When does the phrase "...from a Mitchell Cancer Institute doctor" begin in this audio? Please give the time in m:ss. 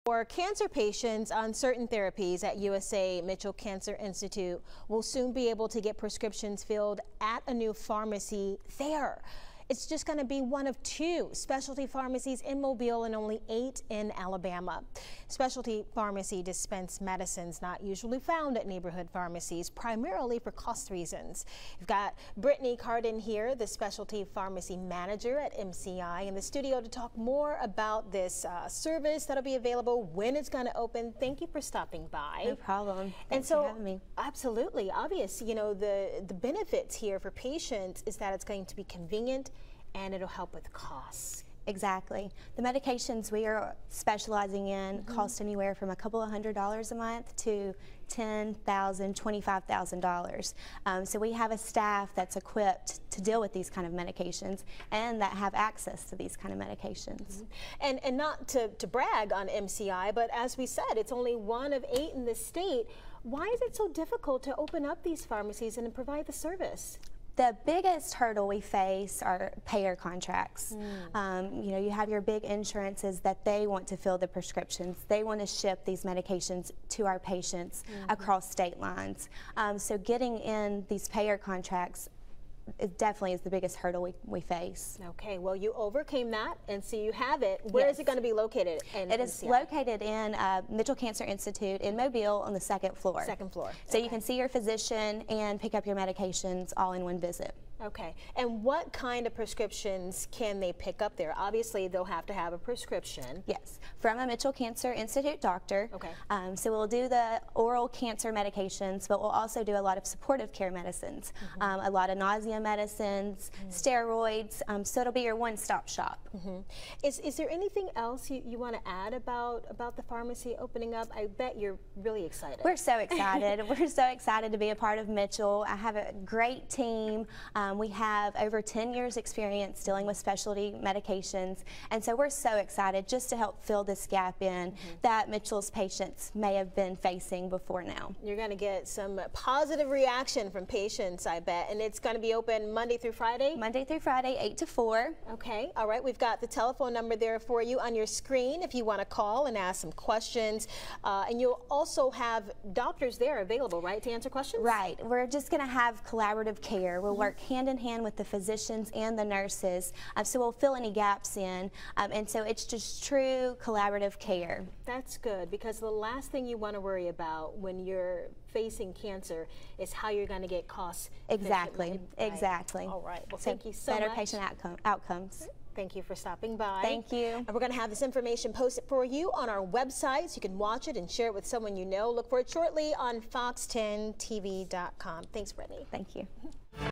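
1:43.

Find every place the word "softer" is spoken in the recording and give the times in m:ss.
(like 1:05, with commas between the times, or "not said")
not said.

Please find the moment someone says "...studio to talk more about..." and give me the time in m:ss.
0:26.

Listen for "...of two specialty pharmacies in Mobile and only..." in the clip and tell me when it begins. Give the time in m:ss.
0:10.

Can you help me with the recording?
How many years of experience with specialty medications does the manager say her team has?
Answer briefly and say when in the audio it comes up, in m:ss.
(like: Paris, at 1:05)
Over 10 years, at 2:08.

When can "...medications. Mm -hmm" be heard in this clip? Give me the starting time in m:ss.
0:56.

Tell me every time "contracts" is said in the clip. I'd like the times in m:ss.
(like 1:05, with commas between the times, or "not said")
1:09, 1:21.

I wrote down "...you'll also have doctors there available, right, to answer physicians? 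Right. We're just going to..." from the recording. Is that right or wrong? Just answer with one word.
wrong.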